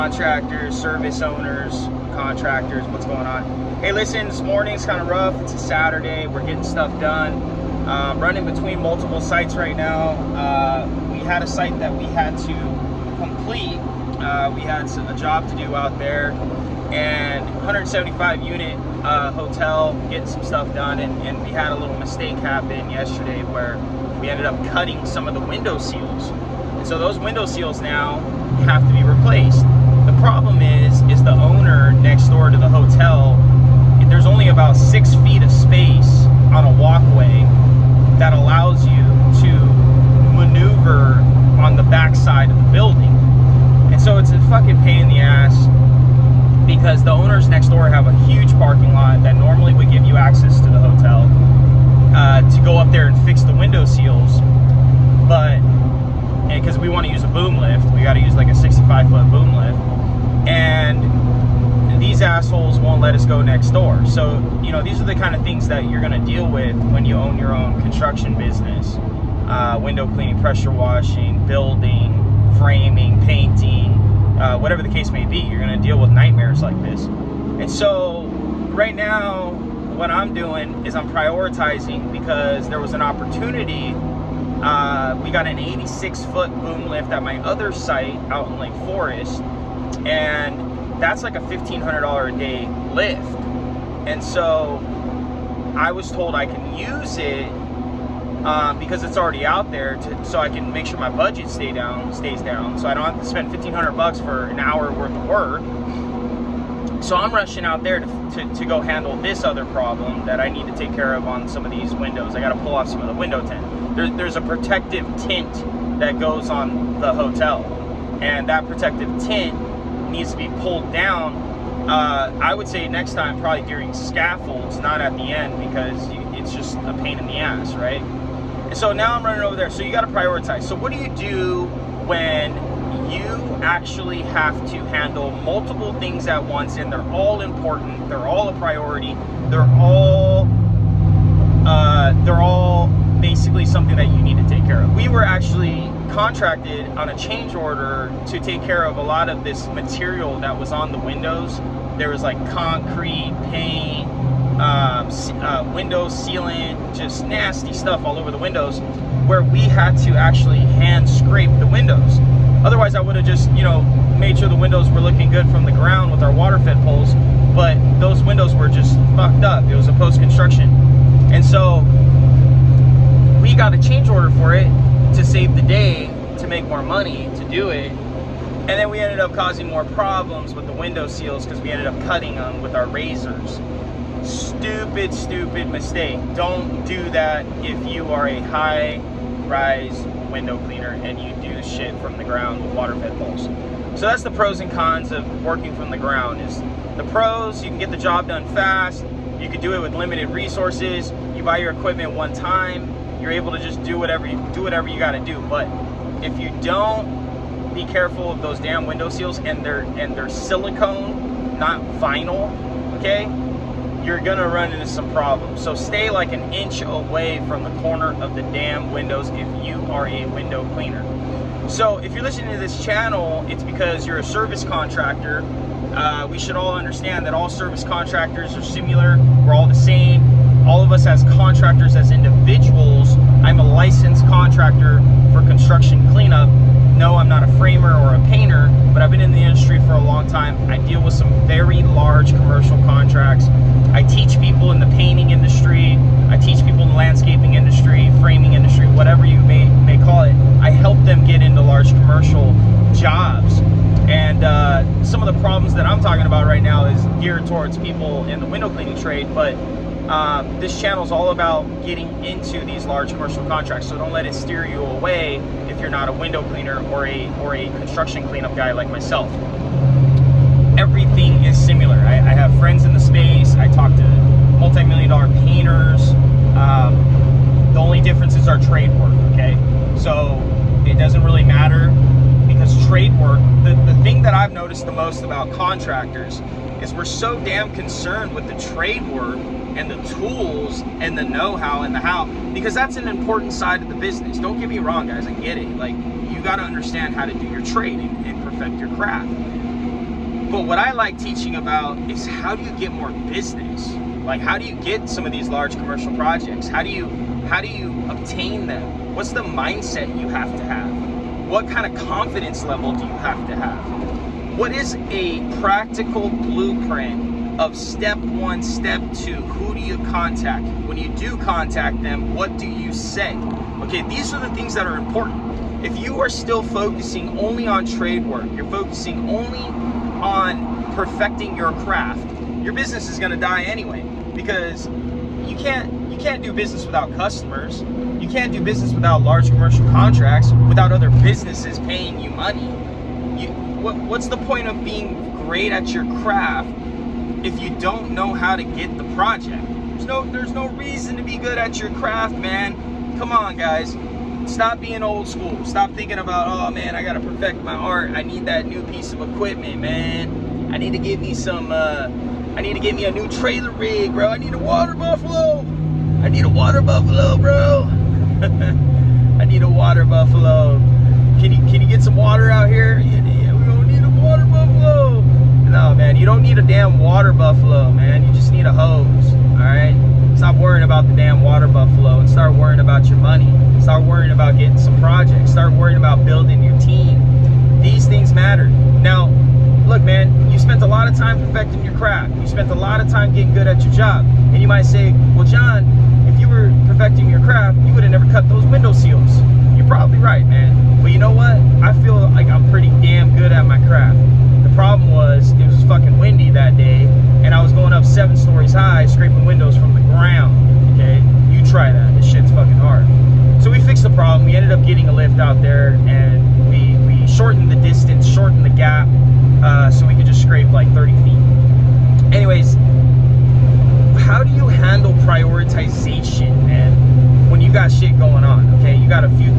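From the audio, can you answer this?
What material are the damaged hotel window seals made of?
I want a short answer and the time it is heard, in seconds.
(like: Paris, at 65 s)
Silicone, at 210 s.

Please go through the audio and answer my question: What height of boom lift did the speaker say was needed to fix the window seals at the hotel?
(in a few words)
65 foot.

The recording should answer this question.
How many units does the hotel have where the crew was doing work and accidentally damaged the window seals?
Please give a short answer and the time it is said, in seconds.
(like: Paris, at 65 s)
175, at 17 s.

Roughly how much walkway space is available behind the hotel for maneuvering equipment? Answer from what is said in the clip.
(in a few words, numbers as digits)
6 feet.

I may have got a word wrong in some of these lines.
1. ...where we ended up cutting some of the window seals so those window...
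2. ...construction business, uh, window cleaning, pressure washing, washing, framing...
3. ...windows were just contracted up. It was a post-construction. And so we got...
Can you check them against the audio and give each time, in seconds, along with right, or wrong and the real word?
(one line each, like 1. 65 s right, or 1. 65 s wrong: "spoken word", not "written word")
1. 23 s right
2. 67 s wrong: "building", not "washing"
3. 168 s wrong: "fucked", not "contracted".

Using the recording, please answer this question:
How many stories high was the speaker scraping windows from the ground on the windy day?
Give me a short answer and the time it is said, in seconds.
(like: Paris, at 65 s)
7, at 408 s.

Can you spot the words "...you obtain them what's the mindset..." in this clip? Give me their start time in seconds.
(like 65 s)
307 s.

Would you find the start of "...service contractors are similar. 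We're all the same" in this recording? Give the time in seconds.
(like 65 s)
227 s.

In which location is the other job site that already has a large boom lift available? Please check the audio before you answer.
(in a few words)
Lake Forest.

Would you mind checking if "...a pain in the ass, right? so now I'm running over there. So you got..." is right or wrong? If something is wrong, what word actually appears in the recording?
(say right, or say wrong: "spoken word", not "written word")
right.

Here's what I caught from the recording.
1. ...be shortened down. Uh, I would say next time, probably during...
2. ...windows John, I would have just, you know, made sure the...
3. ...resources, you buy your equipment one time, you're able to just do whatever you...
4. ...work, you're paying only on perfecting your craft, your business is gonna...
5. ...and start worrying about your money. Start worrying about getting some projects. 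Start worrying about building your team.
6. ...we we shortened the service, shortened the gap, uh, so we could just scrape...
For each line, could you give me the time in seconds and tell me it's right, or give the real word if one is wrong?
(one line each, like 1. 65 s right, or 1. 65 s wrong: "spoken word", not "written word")
1. 120 s wrong: "pulled", not "shortened"
2. 161 s wrong: "Otherwise", not "John"
3. 200 s right
4. 328 s wrong: "focusing", not "paying"
5. 382 s right
6. 416 s wrong: "distance", not "service".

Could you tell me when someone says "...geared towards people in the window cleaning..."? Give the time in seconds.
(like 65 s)
257 s.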